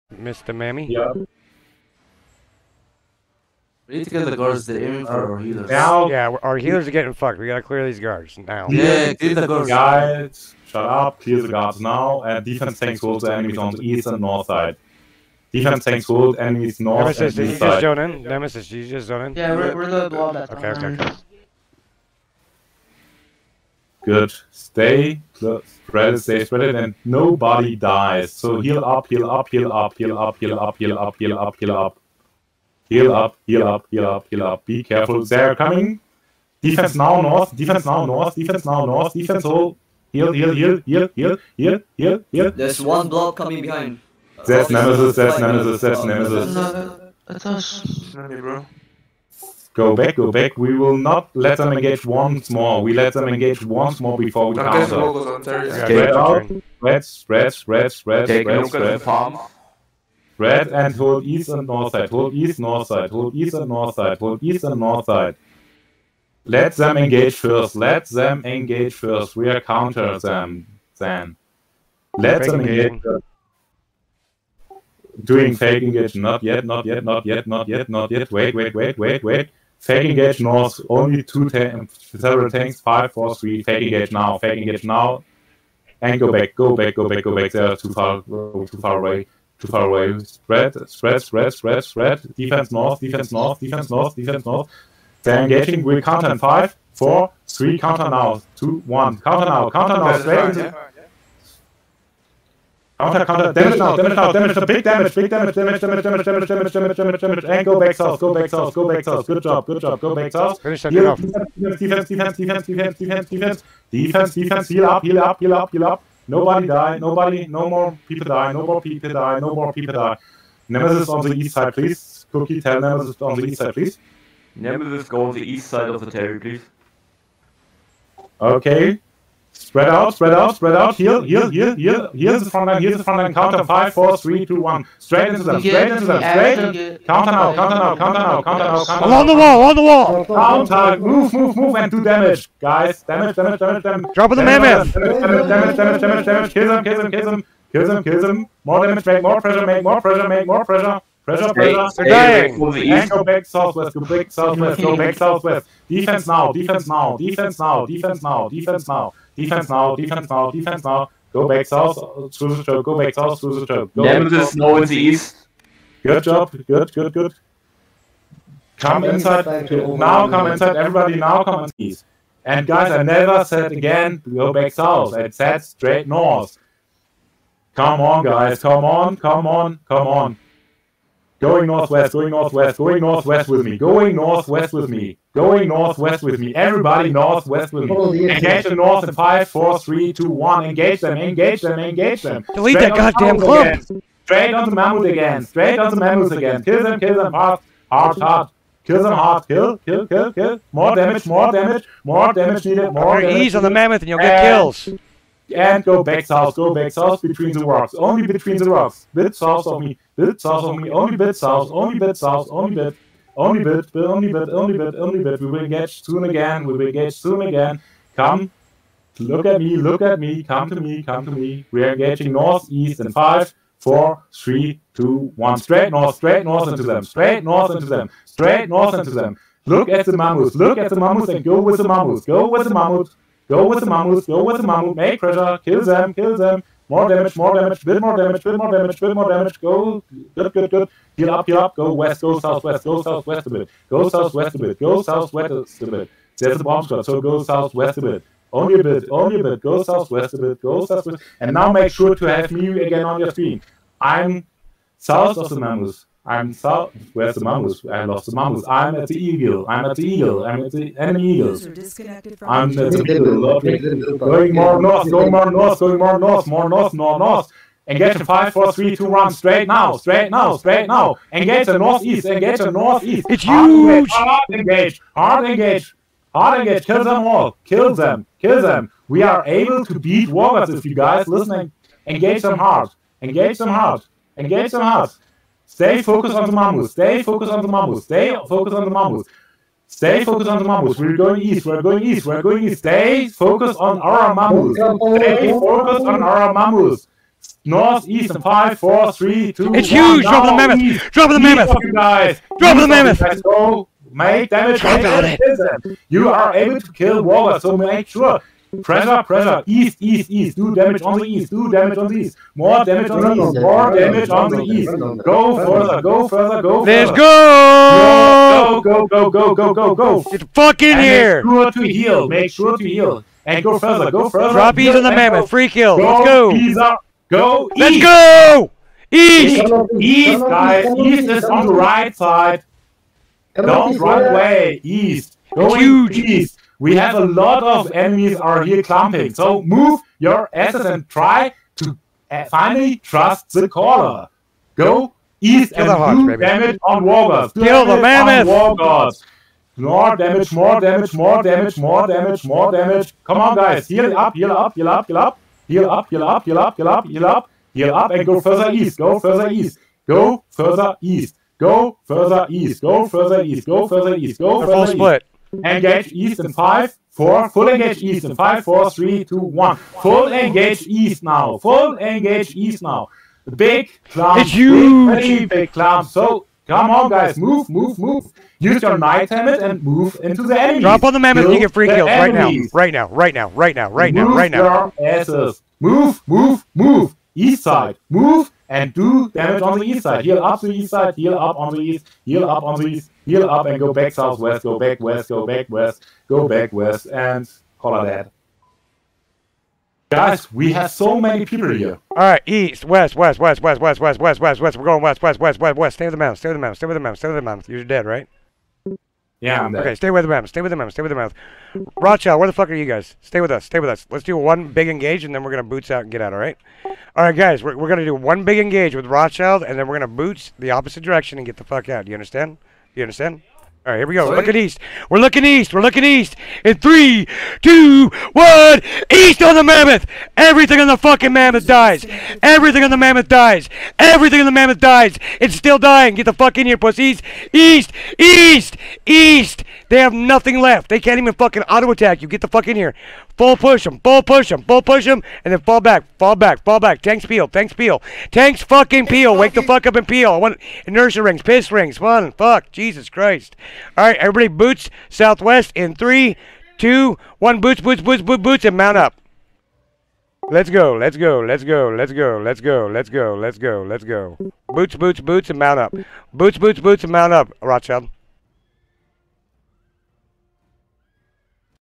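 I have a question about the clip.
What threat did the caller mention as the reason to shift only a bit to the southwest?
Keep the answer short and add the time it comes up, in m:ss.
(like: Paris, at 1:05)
A bomb squad, at 4:06.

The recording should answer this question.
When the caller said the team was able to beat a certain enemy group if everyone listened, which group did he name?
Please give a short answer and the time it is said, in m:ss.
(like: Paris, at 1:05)
Warriors, at 4:39.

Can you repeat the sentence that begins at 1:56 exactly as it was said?
Nobody die, nobody, no more people die, no more people die, no more people die.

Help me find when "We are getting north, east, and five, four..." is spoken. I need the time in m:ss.
3:41.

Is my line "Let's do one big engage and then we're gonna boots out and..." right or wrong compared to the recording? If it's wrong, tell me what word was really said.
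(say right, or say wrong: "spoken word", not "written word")
right.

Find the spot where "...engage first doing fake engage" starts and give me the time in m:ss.
1:12.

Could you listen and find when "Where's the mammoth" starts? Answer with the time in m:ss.
4:17.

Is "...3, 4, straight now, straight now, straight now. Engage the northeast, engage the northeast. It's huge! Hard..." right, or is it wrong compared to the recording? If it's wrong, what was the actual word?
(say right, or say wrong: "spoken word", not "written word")
wrong: "5", not "3".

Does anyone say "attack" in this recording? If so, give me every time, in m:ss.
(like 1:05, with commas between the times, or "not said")
7:21.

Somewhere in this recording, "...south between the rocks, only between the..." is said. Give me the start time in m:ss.
3:26.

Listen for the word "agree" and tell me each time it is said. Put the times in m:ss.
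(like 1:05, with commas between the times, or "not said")
not said.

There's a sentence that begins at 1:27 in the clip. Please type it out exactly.
They are too far, too far away, too far away.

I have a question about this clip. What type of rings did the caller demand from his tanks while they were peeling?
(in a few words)
Inertia rings.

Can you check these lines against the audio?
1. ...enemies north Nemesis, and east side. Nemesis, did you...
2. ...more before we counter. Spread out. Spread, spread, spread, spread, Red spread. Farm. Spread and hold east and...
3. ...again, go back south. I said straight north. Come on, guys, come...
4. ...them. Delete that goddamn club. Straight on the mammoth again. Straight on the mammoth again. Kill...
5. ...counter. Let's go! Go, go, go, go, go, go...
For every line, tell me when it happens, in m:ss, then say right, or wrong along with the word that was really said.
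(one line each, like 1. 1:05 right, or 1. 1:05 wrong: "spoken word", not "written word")
1. 0:16 right
2. 0:54 right
3. 2:53 right
4. 3:12 right
5. 5:16 wrong: "further", not "counter".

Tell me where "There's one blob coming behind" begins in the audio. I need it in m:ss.
0:42.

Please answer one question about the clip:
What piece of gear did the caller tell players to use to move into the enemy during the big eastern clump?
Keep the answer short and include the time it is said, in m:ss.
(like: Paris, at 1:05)
Knight helmet, at 6:18.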